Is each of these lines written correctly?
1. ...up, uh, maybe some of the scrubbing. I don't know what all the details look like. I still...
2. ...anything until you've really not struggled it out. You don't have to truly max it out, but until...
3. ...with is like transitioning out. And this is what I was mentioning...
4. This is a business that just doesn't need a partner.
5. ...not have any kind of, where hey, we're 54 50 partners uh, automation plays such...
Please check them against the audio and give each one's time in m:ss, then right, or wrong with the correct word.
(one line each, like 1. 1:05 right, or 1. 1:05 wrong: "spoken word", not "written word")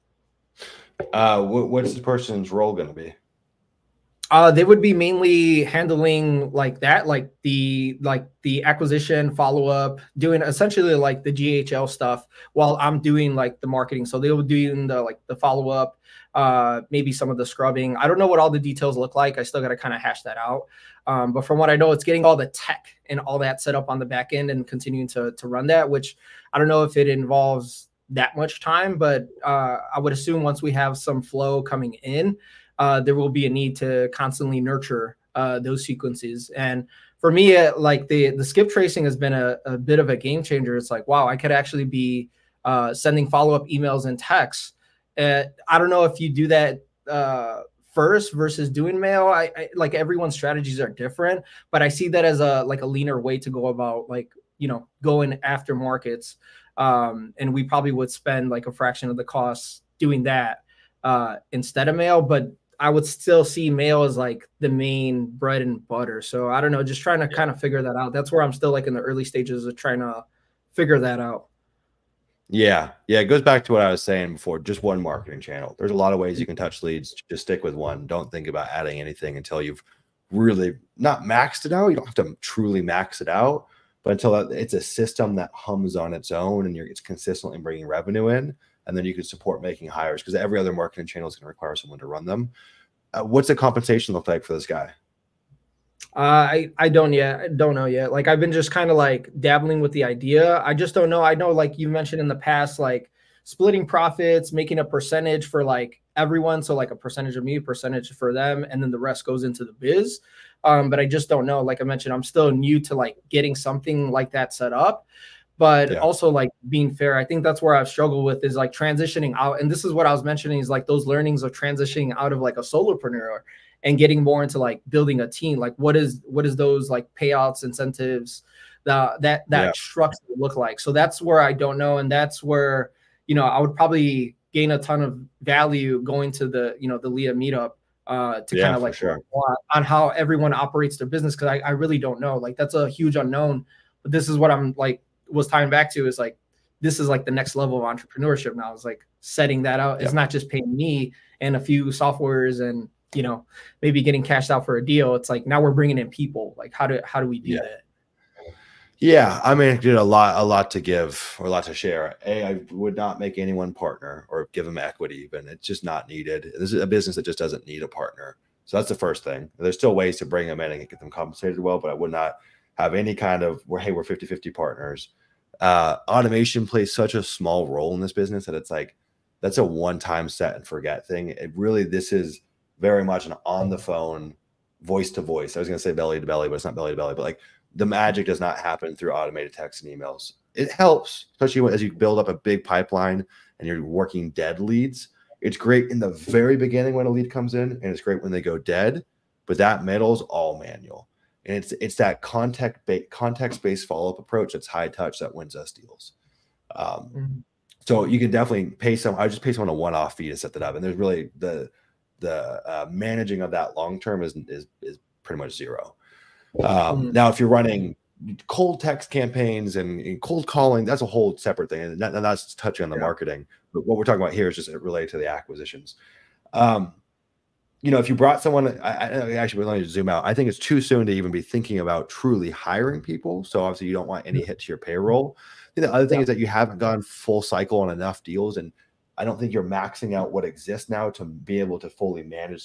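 1. 0:15 right
2. 1:18 wrong: "maxed", not "struggled"
3. 1:58 right
4. 2:46 right
5. 2:52 wrong: "50", not "54".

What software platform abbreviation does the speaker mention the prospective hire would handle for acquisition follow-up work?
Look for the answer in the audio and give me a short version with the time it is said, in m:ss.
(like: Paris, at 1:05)
GHL, at 0:11.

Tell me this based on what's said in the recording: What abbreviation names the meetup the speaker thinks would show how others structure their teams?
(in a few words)
LIA.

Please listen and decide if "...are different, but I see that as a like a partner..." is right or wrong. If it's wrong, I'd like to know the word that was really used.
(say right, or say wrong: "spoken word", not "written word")
wrong: "leaner", not "partner".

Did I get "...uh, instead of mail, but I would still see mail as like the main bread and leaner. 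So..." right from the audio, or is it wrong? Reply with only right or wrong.
wrong.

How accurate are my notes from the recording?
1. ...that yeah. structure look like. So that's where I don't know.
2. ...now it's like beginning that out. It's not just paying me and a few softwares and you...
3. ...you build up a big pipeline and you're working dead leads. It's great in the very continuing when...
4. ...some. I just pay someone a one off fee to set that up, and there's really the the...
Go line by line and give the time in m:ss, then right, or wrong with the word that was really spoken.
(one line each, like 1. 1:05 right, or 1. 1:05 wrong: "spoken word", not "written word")
1. 2:09 right
2. 2:28 wrong: "setting", not "beginning"
3. 3:11 wrong: "beginning", not "continuing"
4. 3:28 right.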